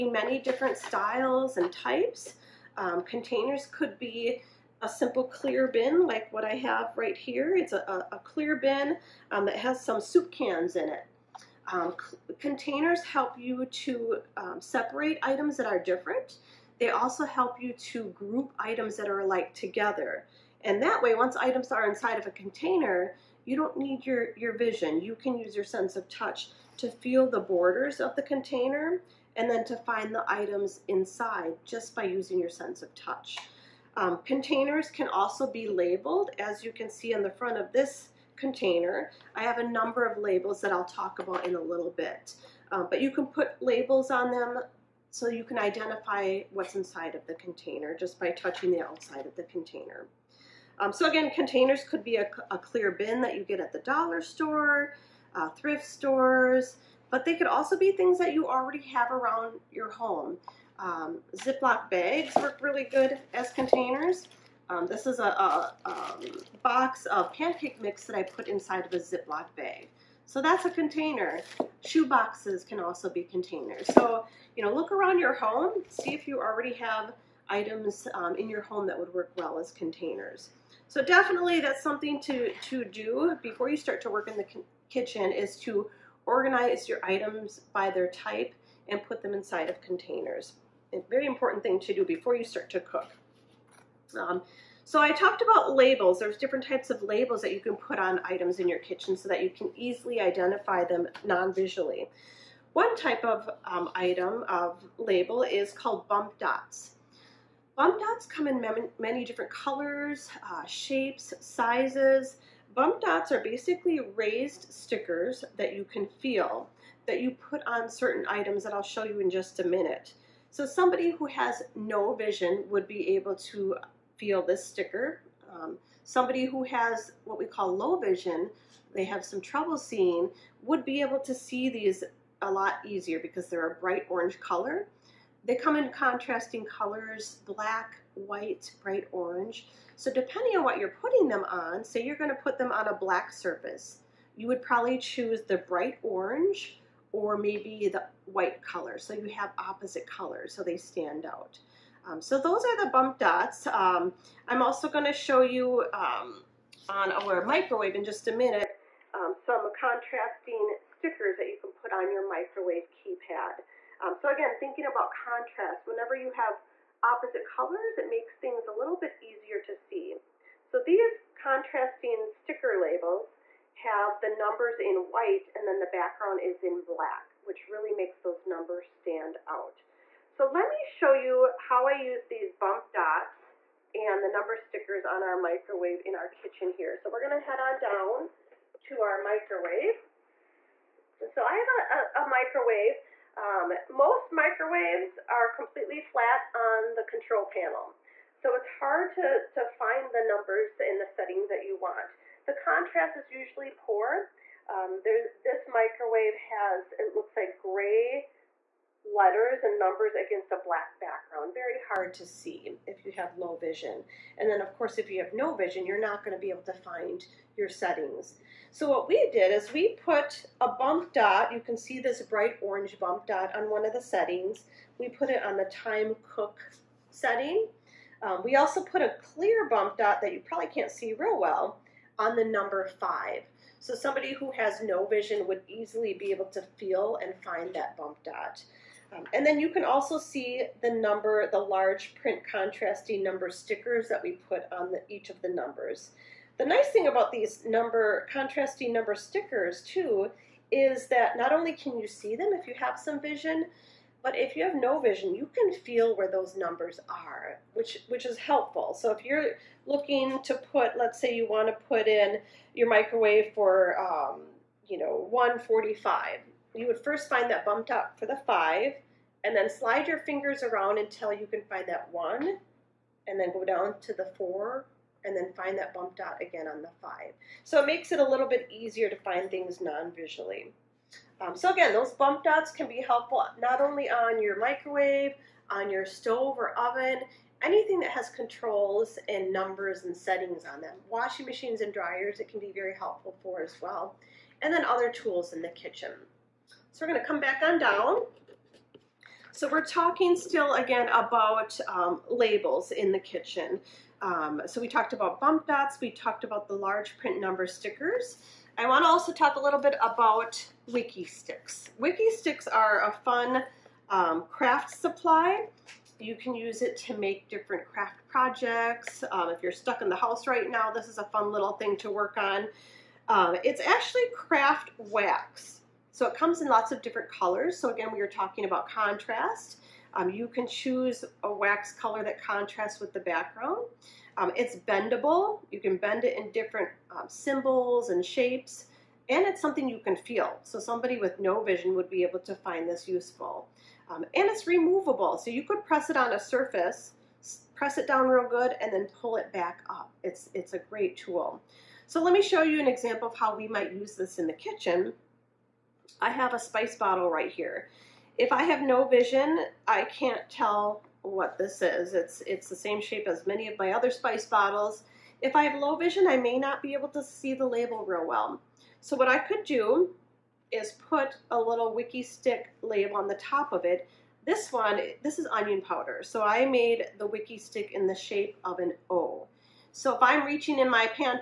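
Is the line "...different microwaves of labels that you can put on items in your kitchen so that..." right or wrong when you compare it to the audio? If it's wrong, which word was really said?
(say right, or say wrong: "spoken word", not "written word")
wrong: "types", not "microwaves".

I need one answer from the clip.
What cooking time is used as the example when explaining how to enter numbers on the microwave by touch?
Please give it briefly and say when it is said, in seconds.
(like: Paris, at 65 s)
145, at 265 s.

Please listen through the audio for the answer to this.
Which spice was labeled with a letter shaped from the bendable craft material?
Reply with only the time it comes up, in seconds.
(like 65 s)
375 s.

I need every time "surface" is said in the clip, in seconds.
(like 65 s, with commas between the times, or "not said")
143 s, 346 s.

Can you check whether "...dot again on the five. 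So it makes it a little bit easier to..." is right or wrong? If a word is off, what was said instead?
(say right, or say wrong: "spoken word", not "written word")
right.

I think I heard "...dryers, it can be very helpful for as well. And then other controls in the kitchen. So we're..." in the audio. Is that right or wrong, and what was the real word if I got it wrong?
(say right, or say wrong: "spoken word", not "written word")
wrong: "tools", not "controls".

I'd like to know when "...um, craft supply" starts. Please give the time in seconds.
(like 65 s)
314 s.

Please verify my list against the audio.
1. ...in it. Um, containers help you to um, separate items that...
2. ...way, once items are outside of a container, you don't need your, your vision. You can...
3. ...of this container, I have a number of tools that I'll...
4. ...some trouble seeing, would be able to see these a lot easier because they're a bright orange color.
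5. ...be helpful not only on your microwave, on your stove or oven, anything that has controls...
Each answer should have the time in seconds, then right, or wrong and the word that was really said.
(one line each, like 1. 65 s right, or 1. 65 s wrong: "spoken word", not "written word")
1. 10 s right
2. 21 s wrong: "inside", not "outside"
3. 37 s wrong: "labels", not "tools"
4. 129 s right
5. 282 s right.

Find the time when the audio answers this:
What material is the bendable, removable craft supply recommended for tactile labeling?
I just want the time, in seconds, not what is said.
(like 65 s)
324 s.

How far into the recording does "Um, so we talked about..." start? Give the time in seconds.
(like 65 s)
304 s.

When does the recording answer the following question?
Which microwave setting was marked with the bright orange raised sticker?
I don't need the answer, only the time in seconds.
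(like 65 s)
225 s.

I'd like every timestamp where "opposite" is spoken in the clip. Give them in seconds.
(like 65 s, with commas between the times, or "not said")
149 s, 167 s.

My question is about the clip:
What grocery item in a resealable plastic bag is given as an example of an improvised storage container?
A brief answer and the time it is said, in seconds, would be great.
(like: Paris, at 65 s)
pancake mix, at 67 s.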